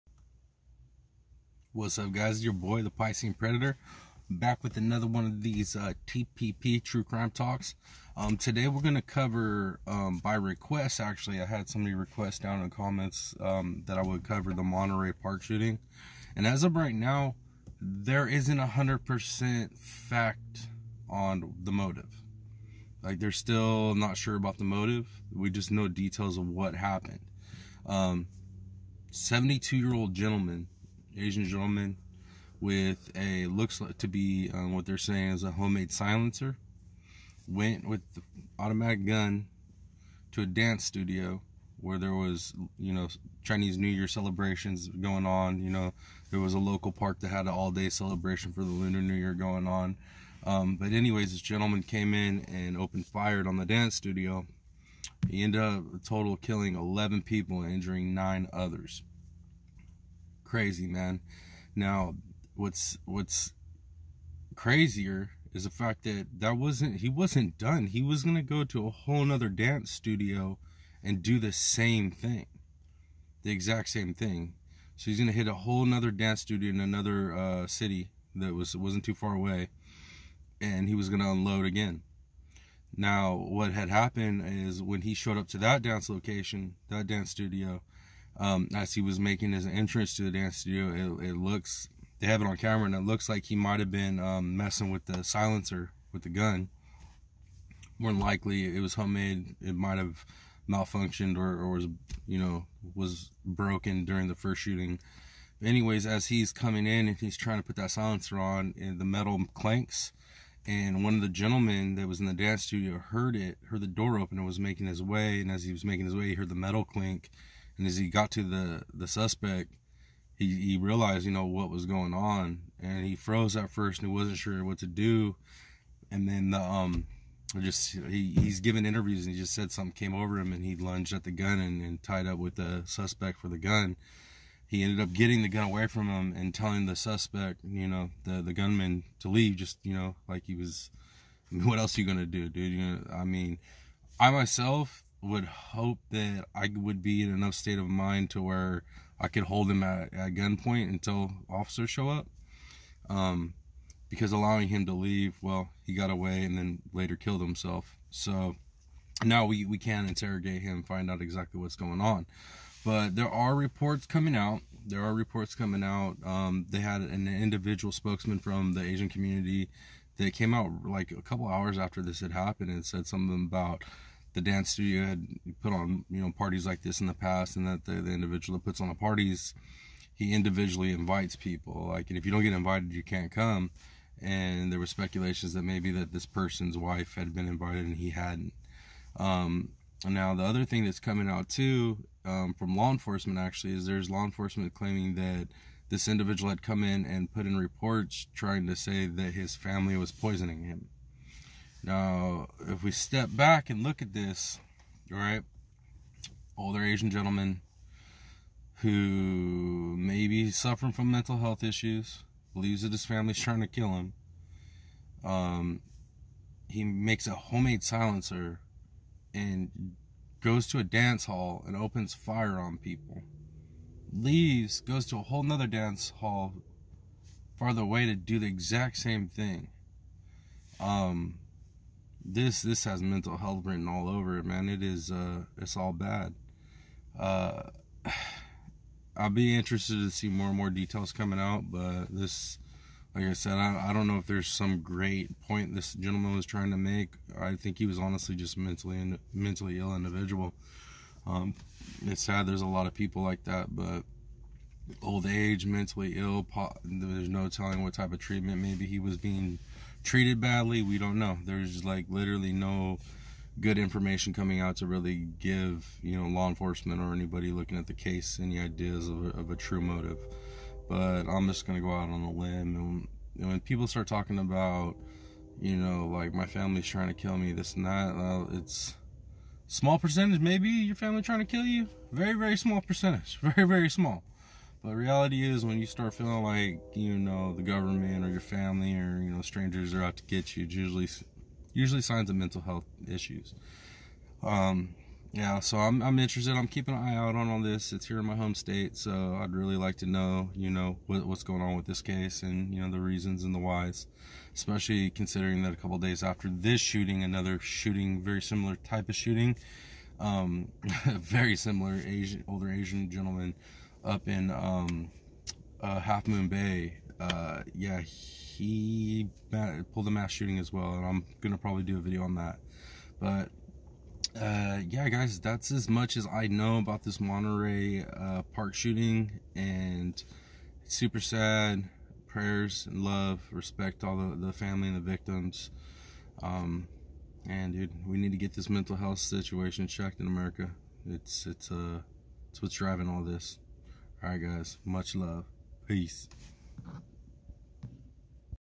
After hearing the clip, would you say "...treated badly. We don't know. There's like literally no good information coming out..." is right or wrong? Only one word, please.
right.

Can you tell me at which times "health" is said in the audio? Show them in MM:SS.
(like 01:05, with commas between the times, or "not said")
03:31, 03:53, 04:52, 05:38.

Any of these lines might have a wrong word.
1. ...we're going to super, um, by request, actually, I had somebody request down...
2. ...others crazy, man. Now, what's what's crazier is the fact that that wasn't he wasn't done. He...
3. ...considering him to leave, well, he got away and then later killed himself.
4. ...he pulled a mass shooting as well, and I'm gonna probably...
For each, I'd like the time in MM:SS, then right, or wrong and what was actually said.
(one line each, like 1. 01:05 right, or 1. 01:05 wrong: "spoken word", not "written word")
1. 00:08 wrong: "cover", not "super"
2. 00:58 right
3. 02:34 wrong: "allowing", not "considering"
4. 05:18 right.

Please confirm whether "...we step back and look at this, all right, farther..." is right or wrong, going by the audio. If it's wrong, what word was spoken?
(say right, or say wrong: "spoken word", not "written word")
wrong: "older", not "farther".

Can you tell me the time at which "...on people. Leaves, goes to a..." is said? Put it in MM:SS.
03:42.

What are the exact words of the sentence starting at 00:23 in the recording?
Like, they're still not sure about the motive.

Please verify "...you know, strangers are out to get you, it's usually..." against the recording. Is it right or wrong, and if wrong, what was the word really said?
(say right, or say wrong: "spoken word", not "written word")
right.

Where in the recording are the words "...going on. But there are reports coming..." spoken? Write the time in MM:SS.
02:41.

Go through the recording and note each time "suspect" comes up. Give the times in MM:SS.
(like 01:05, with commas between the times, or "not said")
01:59, 02:12, 02:16.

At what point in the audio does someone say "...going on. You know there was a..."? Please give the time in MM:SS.
00:44.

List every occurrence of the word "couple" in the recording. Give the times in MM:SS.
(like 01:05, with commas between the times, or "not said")
02:51, 05:05.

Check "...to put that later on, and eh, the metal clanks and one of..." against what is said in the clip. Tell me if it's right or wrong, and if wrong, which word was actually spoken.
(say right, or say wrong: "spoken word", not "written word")
wrong: "silencer", not "later".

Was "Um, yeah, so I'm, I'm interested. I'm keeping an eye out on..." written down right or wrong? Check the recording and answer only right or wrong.
right.